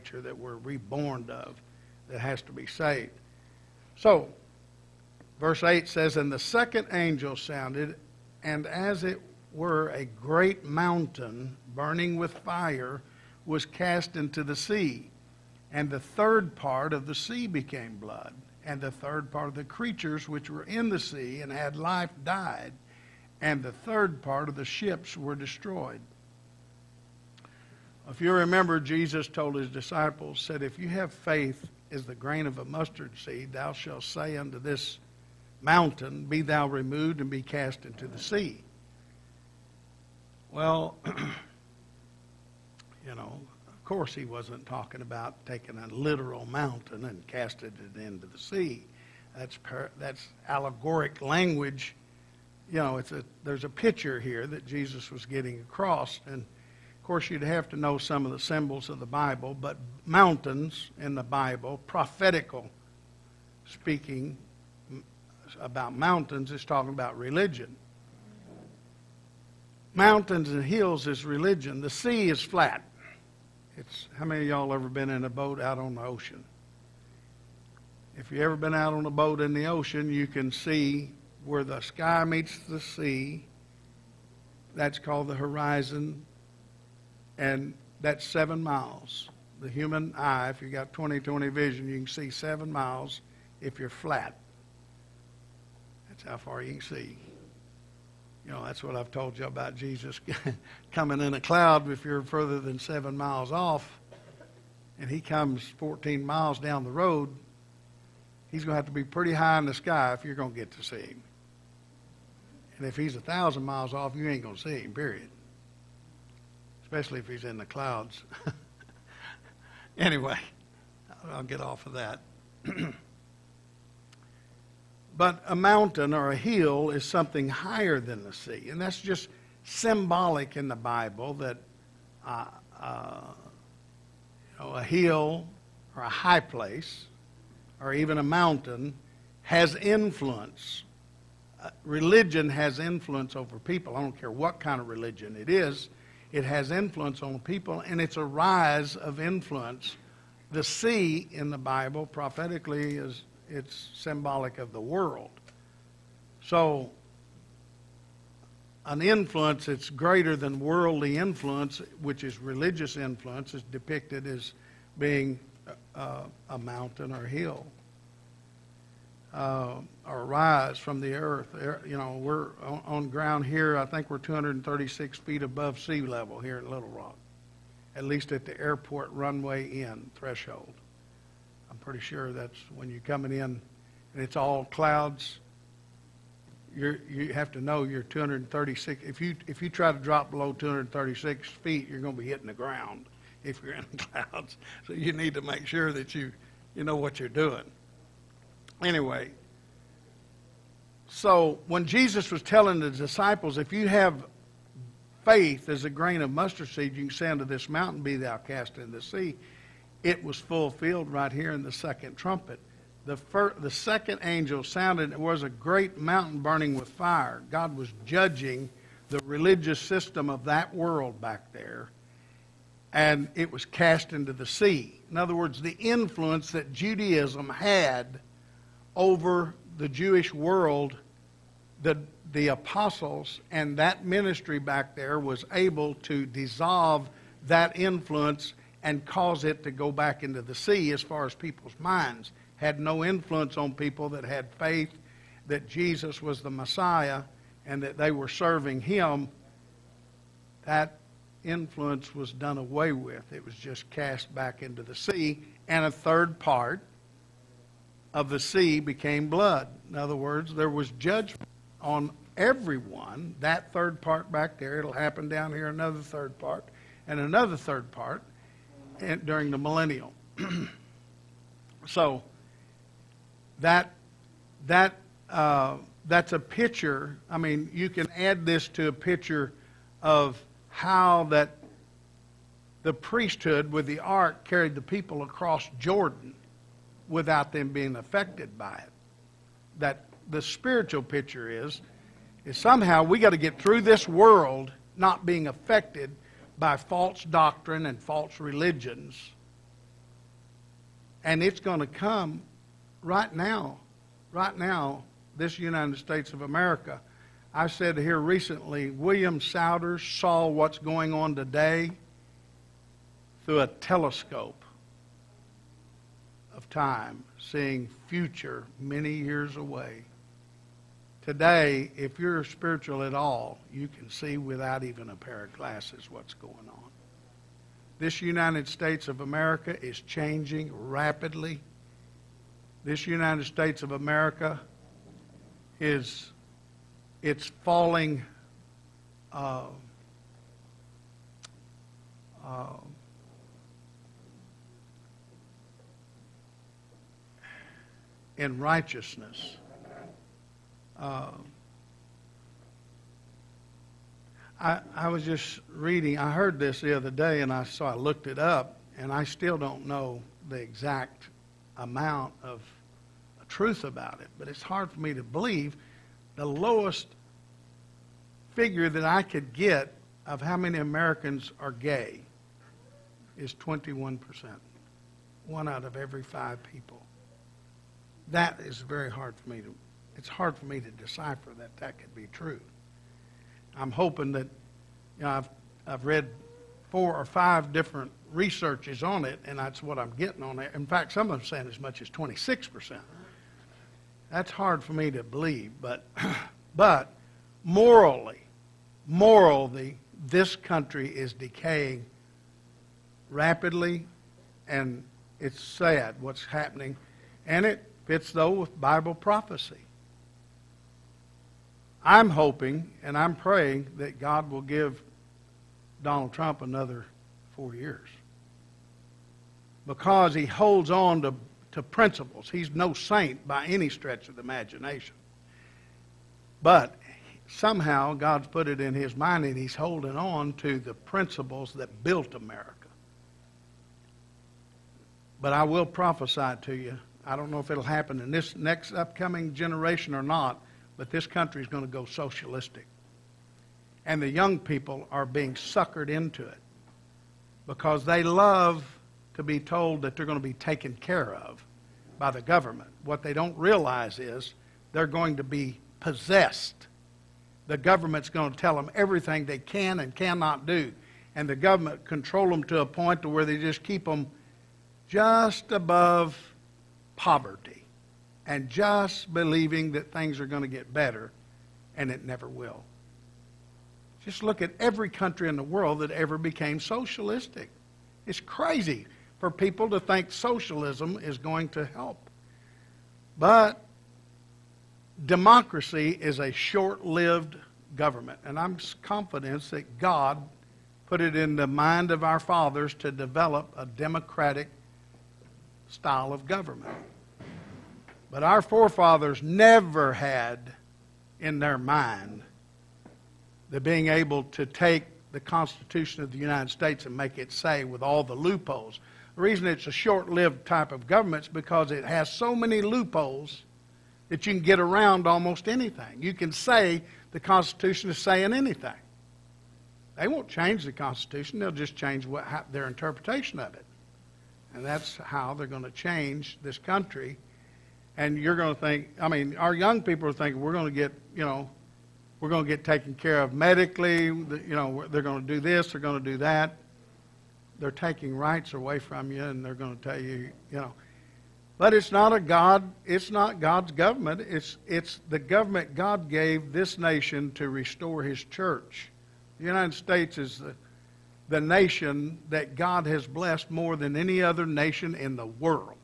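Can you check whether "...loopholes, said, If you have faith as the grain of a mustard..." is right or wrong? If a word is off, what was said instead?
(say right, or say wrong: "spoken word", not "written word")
wrong: "disciples", not "loopholes".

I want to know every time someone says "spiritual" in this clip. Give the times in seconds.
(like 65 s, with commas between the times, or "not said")
290 s, 322 s.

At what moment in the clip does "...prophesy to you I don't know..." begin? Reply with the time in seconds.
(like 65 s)
435 s.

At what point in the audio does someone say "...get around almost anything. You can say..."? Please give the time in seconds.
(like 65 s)
514 s.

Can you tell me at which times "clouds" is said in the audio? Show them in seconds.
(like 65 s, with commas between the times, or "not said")
101 s, 117 s, 184 s, 194 s.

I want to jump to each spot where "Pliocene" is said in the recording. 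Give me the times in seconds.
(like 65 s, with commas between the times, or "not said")
not said.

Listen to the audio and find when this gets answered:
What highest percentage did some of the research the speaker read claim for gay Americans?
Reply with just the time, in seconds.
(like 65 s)
392 s.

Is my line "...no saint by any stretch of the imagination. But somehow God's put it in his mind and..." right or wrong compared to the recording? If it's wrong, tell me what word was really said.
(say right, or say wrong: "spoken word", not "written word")
right.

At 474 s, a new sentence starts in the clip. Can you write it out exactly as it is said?
Just look at every country in the world that ever became socialistic.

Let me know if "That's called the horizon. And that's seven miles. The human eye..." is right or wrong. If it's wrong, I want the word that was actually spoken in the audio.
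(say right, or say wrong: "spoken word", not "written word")
right.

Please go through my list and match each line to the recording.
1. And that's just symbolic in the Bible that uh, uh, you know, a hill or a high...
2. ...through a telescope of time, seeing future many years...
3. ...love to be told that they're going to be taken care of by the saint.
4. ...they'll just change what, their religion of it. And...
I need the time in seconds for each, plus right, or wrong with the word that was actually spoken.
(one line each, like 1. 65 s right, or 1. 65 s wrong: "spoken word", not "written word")
1. 128 s right
2. 313 s right
3. 448 s wrong: "government", not "saint"
4. 521 s wrong: "interpretation", not "religion".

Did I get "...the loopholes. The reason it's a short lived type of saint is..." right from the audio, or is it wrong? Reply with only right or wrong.
wrong.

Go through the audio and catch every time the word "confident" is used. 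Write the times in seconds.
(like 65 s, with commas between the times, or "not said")
489 s.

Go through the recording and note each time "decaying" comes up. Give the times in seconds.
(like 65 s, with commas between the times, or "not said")
401 s.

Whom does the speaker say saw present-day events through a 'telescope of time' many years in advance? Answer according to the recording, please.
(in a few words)
William Sowders.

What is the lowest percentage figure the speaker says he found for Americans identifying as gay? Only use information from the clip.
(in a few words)
21%.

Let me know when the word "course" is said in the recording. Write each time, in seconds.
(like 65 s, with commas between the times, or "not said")
43 s, 57 s.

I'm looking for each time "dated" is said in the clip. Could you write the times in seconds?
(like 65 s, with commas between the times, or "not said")
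not said.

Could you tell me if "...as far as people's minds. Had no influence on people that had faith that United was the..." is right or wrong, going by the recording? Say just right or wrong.
wrong.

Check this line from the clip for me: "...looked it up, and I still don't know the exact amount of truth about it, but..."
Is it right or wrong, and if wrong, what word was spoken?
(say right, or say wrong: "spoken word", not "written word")
right.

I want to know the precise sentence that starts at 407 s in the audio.
And it fits though with Bible prophecy.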